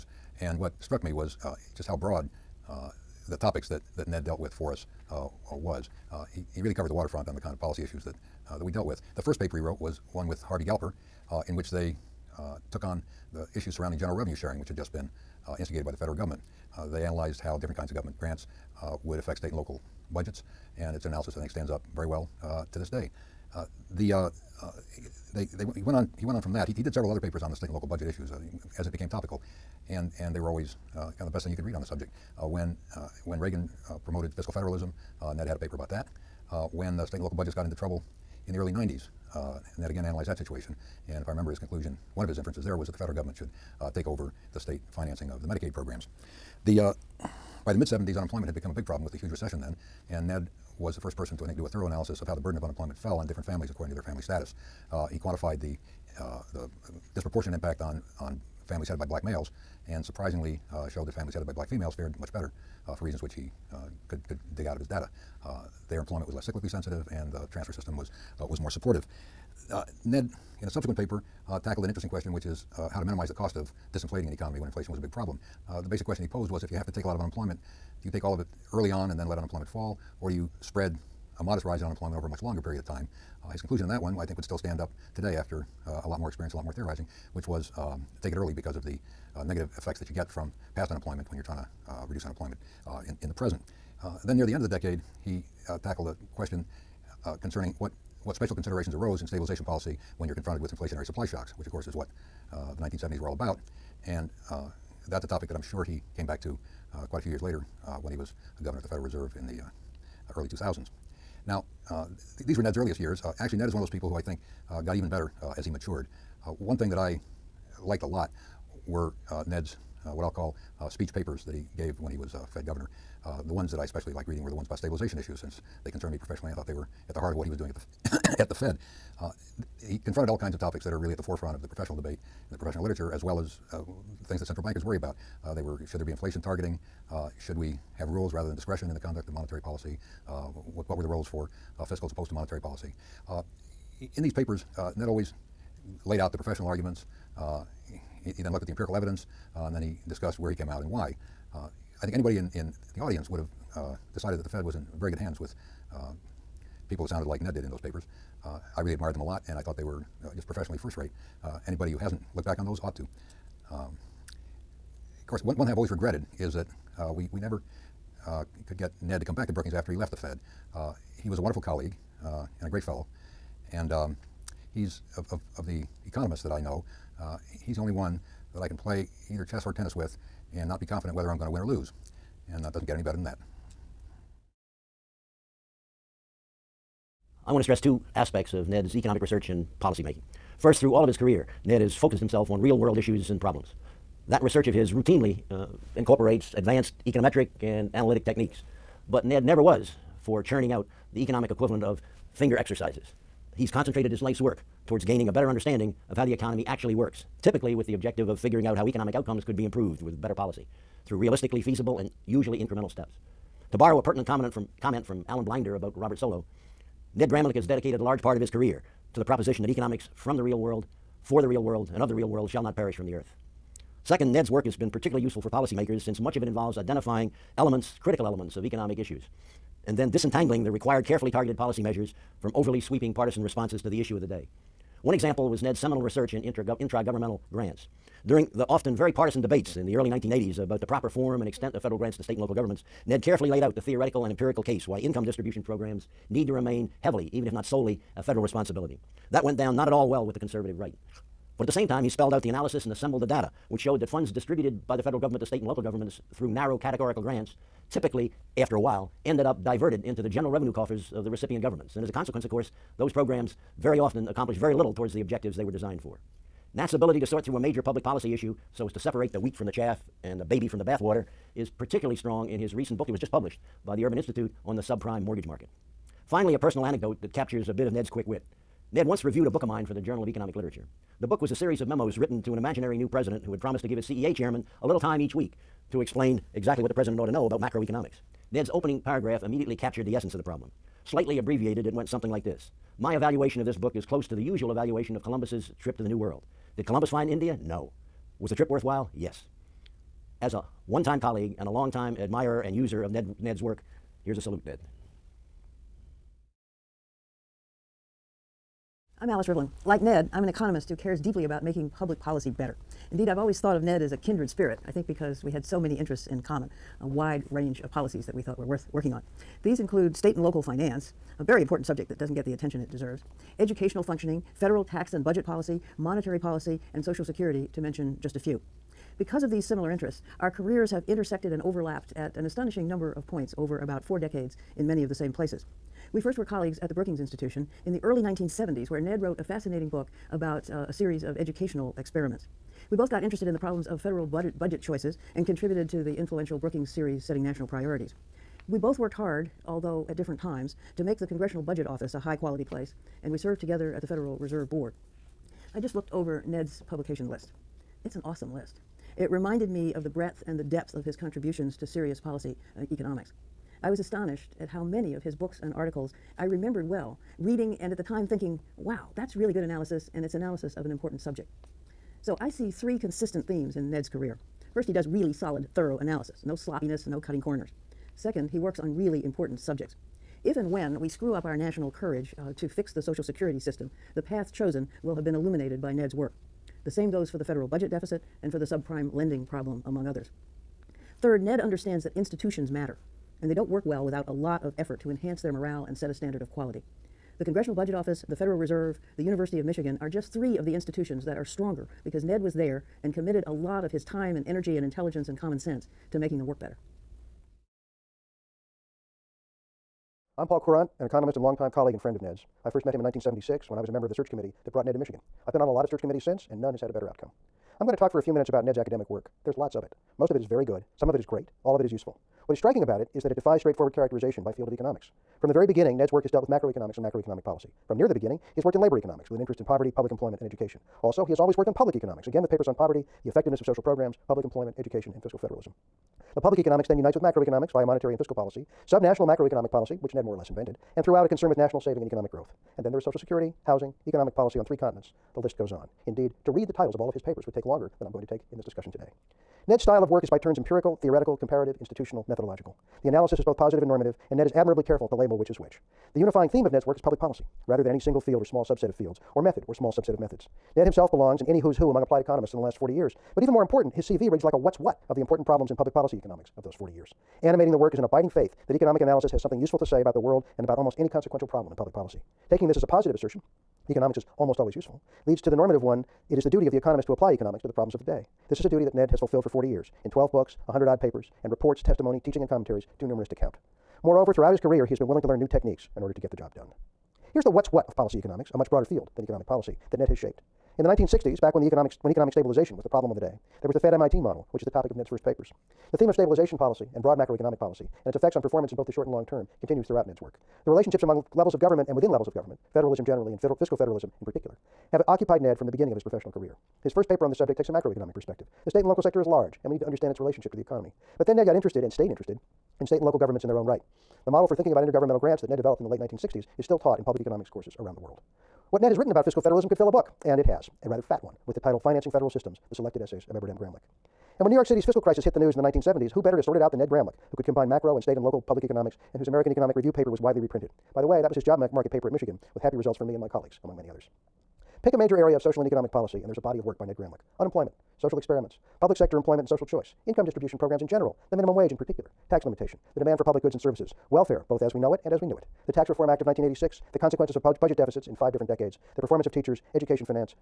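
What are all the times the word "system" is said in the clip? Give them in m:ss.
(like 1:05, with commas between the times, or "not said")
1:07, 6:23, 8:42.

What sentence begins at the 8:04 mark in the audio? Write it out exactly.
Moreover, throughout his career, he has been willing to learn new techniques in order to get the job done.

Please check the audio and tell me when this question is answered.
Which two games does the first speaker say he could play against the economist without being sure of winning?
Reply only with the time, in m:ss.
2:59.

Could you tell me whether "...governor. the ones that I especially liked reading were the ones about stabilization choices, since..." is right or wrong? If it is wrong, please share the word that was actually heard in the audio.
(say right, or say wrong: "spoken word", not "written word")
wrong: "issues", not "choices".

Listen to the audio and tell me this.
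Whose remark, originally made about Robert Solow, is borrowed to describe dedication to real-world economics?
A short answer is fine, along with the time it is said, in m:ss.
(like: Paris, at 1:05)
Alan Blinder, at 3:35.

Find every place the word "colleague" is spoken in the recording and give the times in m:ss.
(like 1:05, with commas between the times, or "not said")
2:51, 5:01, 5:36, 6:51, 8:53.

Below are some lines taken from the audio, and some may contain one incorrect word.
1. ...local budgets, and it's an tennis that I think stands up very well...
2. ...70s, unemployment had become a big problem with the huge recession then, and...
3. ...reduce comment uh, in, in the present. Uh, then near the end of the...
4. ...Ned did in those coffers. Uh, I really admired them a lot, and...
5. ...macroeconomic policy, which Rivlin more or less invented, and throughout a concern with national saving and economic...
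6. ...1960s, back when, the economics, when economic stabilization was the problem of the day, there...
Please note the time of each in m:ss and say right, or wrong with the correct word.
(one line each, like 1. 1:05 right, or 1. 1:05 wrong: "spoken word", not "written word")
1. 0:19 wrong: "analysis", not "tennis"
2. 0:47 right
3. 1:32 wrong: "unemployment", not "comment"
4. 2:37 wrong: "papers", not "coffers"
5. 7:19 wrong: "Ned", not "Rivlin"
6. 8:10 right.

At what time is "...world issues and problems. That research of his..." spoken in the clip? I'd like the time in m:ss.
3:12.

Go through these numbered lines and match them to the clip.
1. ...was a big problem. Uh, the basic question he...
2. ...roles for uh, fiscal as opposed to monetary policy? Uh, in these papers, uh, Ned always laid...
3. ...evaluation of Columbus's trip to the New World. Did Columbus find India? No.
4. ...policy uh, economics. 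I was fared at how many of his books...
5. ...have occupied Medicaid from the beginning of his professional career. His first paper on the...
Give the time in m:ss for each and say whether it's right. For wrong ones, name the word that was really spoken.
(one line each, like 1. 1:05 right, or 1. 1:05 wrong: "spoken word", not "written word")
1. 1:14 right
2. 2:21 right
3. 4:54 right
4. 6:02 wrong: "astonished", not "fared"
5. 8:24 wrong: "Ned", not "Medicaid".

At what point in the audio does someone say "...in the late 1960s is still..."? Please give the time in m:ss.
8:35.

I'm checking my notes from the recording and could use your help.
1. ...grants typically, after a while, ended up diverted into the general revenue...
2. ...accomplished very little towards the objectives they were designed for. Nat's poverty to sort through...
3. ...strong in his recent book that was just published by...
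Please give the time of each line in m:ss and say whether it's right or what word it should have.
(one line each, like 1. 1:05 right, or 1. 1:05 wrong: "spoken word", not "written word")
1. 4:17 right
2. 4:24 wrong: "ability", not "poverty"
3. 4:32 right.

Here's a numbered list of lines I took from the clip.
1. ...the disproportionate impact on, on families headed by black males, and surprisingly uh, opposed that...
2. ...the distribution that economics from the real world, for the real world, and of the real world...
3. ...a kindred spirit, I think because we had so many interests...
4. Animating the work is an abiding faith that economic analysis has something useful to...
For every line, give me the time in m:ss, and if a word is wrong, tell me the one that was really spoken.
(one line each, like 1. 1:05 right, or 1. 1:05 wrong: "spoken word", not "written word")
1. 0:56 wrong: "showed", not "opposed"
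2. 3:39 wrong: "proposition", not "distribution"
3. 5:14 right
4. 7:47 right.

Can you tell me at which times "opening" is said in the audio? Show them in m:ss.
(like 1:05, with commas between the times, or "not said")
4:48.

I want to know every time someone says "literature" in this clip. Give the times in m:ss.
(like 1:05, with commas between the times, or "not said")
2:12, 4:40.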